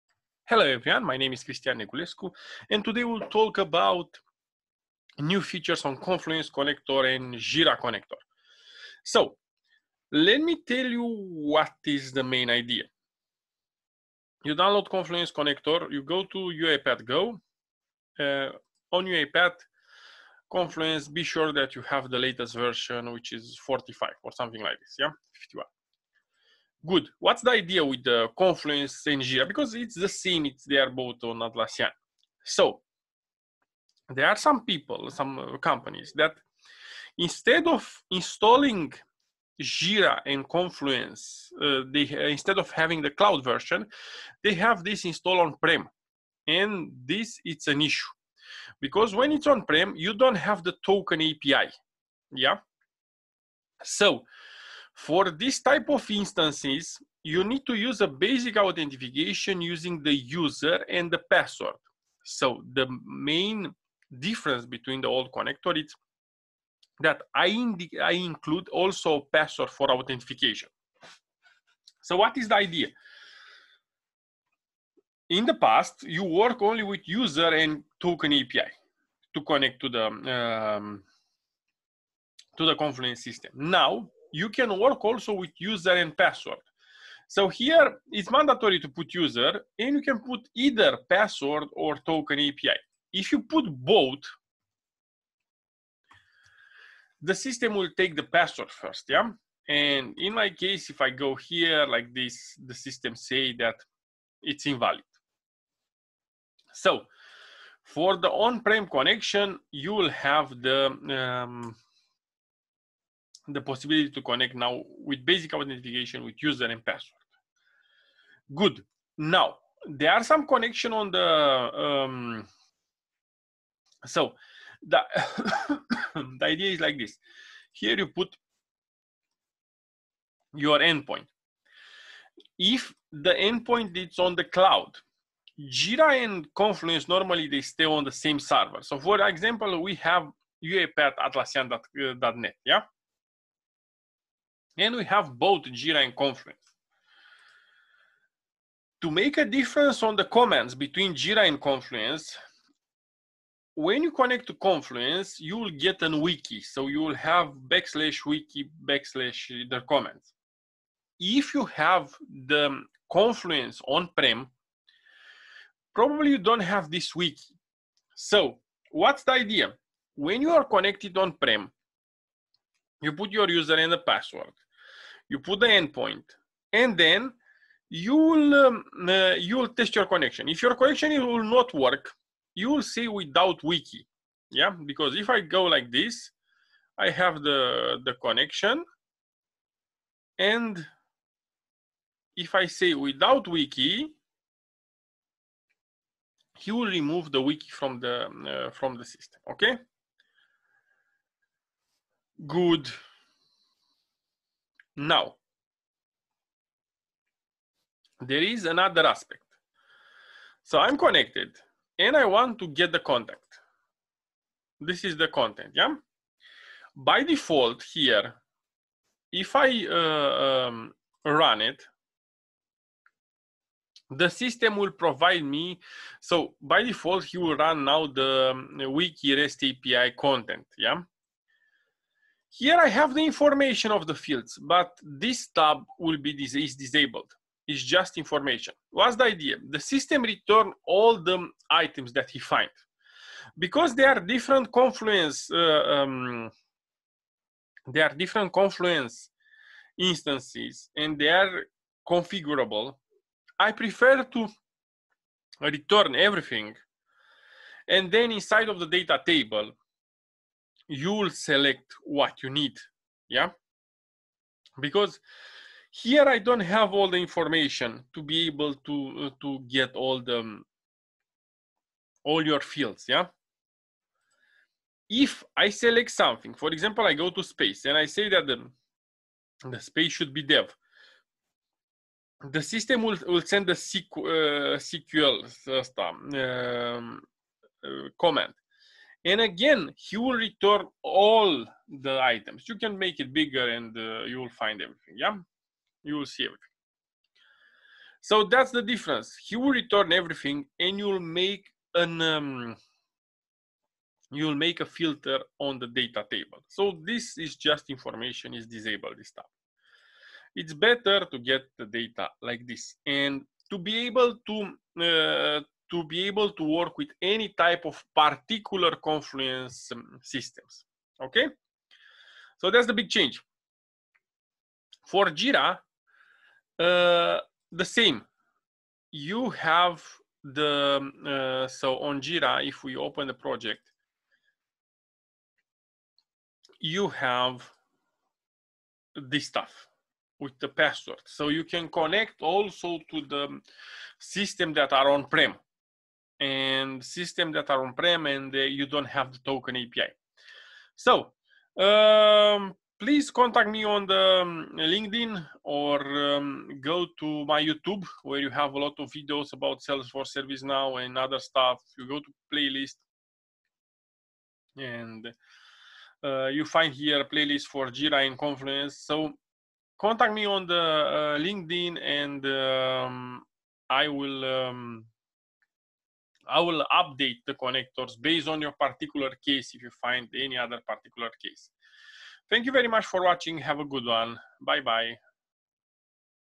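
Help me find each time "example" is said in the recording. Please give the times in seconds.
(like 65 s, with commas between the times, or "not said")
139 s, 276 s.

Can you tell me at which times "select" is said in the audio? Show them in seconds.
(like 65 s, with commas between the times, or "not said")
261 s, 275 s.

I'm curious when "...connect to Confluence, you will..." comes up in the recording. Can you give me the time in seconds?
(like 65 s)
154 s.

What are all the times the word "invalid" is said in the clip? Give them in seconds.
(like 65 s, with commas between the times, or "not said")
104 s.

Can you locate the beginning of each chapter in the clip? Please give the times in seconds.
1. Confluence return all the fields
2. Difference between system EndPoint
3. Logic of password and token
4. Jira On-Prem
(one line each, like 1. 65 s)
1. 210 s
2. 120 s
3. 45 s
4. 330 s.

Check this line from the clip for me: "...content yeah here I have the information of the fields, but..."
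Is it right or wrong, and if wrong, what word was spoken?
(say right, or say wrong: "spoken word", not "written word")
right.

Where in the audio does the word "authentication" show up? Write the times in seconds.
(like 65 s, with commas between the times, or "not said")
58 s, 69 s, 115 s.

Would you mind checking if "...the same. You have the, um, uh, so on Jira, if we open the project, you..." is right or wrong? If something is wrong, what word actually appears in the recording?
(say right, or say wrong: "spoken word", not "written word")
right.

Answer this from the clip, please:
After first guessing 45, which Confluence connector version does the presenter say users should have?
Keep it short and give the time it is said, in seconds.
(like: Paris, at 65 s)
51, at 25 s.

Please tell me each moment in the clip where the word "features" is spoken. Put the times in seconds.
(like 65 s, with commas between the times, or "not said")
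5 s.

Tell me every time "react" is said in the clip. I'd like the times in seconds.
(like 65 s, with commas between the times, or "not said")
not said.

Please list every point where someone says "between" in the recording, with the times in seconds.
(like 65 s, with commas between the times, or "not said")
64 s, 150 s.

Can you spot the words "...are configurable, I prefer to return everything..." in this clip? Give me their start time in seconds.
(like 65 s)
251 s.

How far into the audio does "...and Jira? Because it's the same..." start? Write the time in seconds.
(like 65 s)
29 s.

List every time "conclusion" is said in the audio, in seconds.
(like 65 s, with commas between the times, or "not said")
not said.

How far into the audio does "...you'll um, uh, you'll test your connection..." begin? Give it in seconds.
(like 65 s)
177 s.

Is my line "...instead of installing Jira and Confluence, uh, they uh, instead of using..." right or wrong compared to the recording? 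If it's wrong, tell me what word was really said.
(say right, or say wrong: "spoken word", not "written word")
wrong: "having", not "using".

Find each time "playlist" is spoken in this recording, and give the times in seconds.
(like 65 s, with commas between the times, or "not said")
362 s, 367 s.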